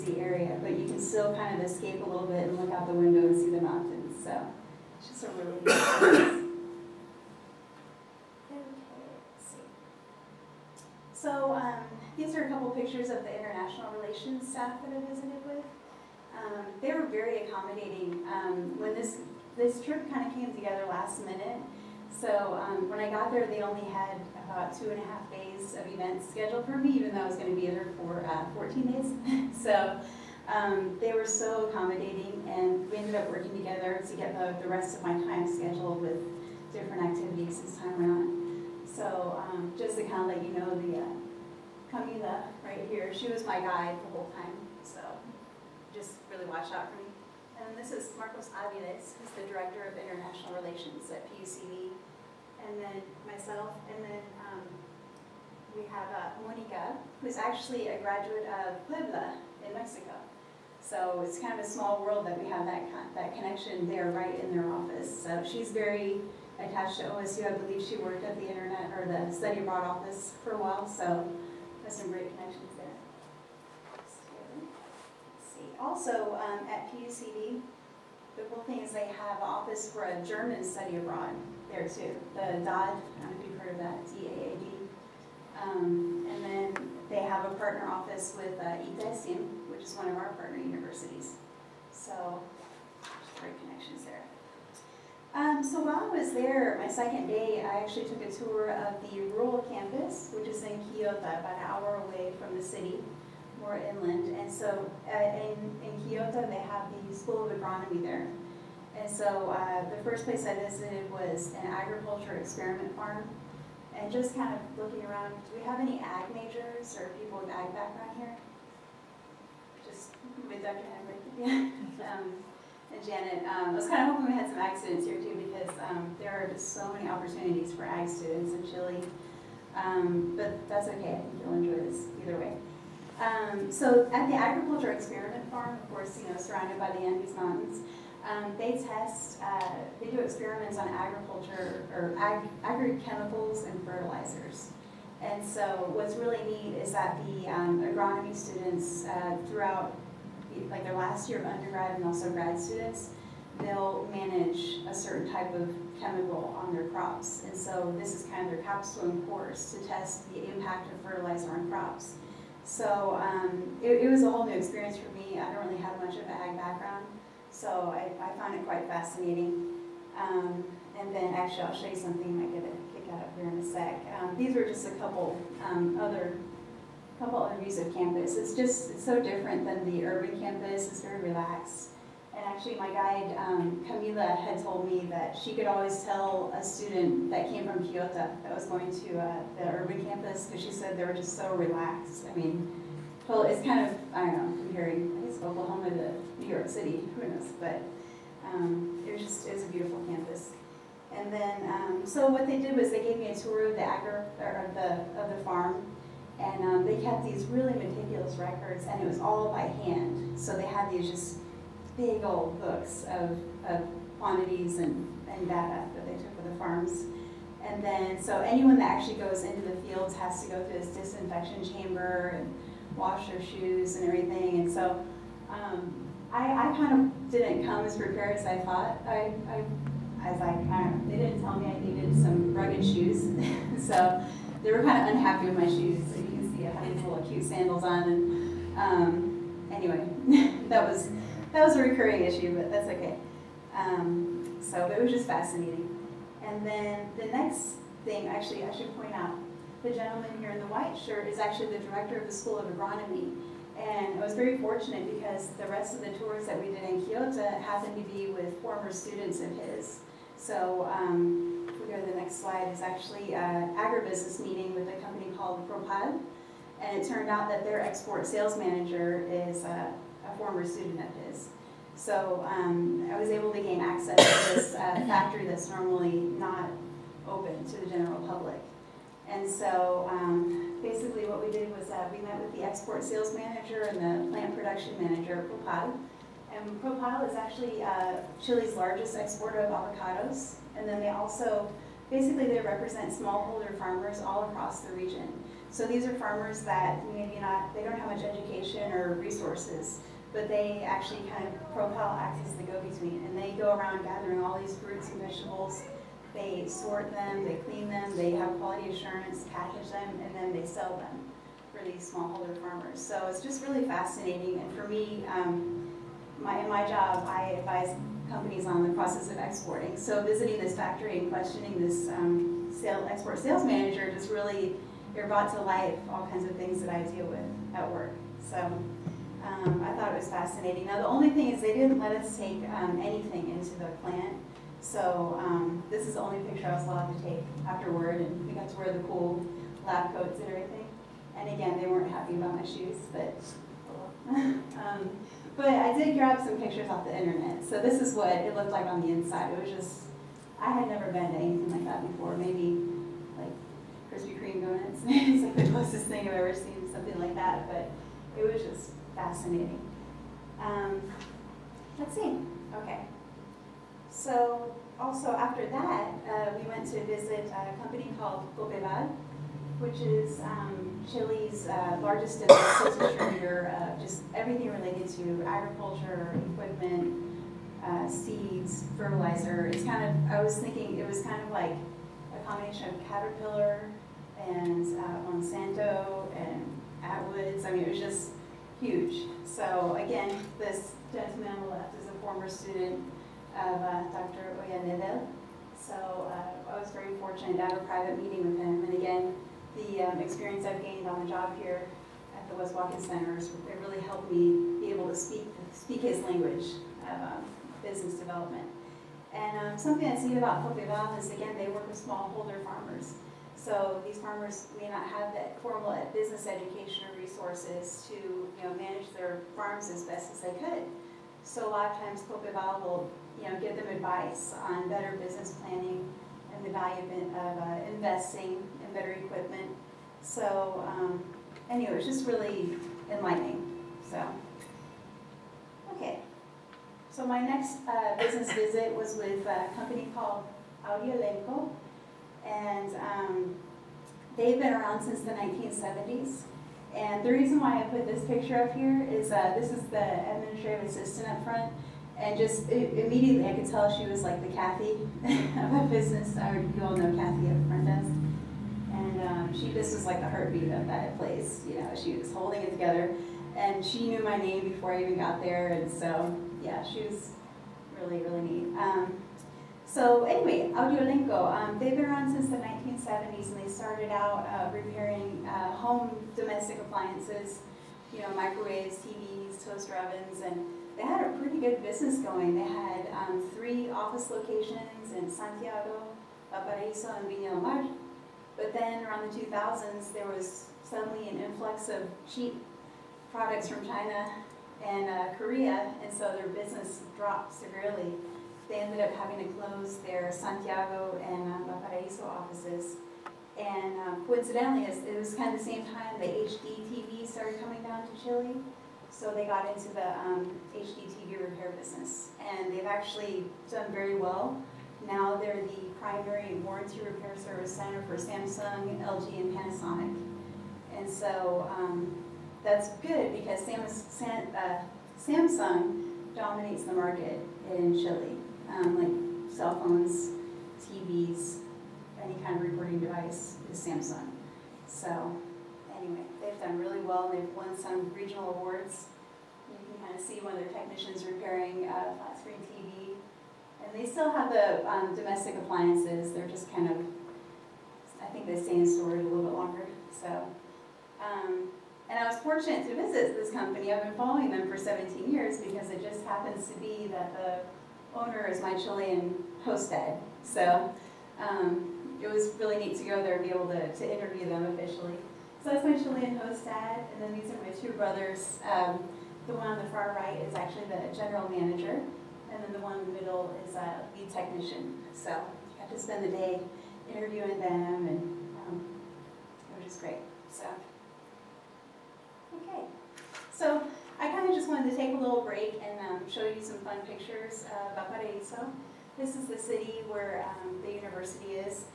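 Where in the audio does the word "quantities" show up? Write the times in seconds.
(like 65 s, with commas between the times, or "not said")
214 s.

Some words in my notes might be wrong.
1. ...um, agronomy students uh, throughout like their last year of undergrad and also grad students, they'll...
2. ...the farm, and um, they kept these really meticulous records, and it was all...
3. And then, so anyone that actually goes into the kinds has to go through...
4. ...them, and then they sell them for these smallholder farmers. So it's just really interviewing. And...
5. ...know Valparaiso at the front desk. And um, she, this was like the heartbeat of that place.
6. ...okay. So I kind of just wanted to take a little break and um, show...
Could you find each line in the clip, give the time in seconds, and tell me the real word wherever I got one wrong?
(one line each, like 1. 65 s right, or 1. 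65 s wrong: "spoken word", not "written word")
1. 147 s right
2. 205 s right
3. 217 s wrong: "fields", not "kinds"
4. 309 s wrong: "fascinating", not "interviewing"
5. 456 s wrong: "Kathy", not "Valparaiso"
6. 582 s right.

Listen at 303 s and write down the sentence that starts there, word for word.
And they go around gathering all these fruits and vegetables.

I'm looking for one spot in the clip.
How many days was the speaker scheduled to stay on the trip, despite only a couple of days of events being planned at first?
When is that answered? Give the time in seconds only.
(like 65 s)
28 s.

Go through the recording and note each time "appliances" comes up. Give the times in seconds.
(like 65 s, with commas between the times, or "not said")
476 s, 545 s.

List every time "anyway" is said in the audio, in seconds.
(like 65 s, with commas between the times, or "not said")
239 s, 431 s, 470 s, 535 s.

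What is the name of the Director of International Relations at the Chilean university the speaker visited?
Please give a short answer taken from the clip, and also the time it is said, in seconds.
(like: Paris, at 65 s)
Marcos Aviles, at 48 s.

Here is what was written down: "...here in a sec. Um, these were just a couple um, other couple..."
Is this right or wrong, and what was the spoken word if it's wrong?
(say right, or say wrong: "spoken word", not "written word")
right.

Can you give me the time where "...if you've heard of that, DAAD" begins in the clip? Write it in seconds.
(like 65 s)
83 s.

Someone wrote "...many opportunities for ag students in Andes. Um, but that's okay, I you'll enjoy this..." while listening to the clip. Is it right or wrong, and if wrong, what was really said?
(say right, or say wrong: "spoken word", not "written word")
wrong: "Chile", not "Andes".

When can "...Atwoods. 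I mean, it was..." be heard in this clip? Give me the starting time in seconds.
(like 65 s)
387 s.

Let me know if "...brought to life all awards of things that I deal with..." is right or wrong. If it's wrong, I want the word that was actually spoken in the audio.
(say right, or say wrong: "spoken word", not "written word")
wrong: "kinds", not "awards".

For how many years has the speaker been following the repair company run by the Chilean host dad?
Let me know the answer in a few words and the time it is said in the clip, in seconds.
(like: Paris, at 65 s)
17, at 554 s.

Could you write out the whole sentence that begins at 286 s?
And Propal is actually uh, Chile's largest exporter of avocados.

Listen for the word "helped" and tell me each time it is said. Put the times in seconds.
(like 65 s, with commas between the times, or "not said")
404 s.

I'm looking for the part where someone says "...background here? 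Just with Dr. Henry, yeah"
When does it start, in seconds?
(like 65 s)
117 s.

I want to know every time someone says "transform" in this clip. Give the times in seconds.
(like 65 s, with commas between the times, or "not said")
not said.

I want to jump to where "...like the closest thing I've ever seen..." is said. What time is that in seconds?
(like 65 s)
355 s.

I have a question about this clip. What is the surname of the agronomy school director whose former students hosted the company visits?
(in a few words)
Oyanedel.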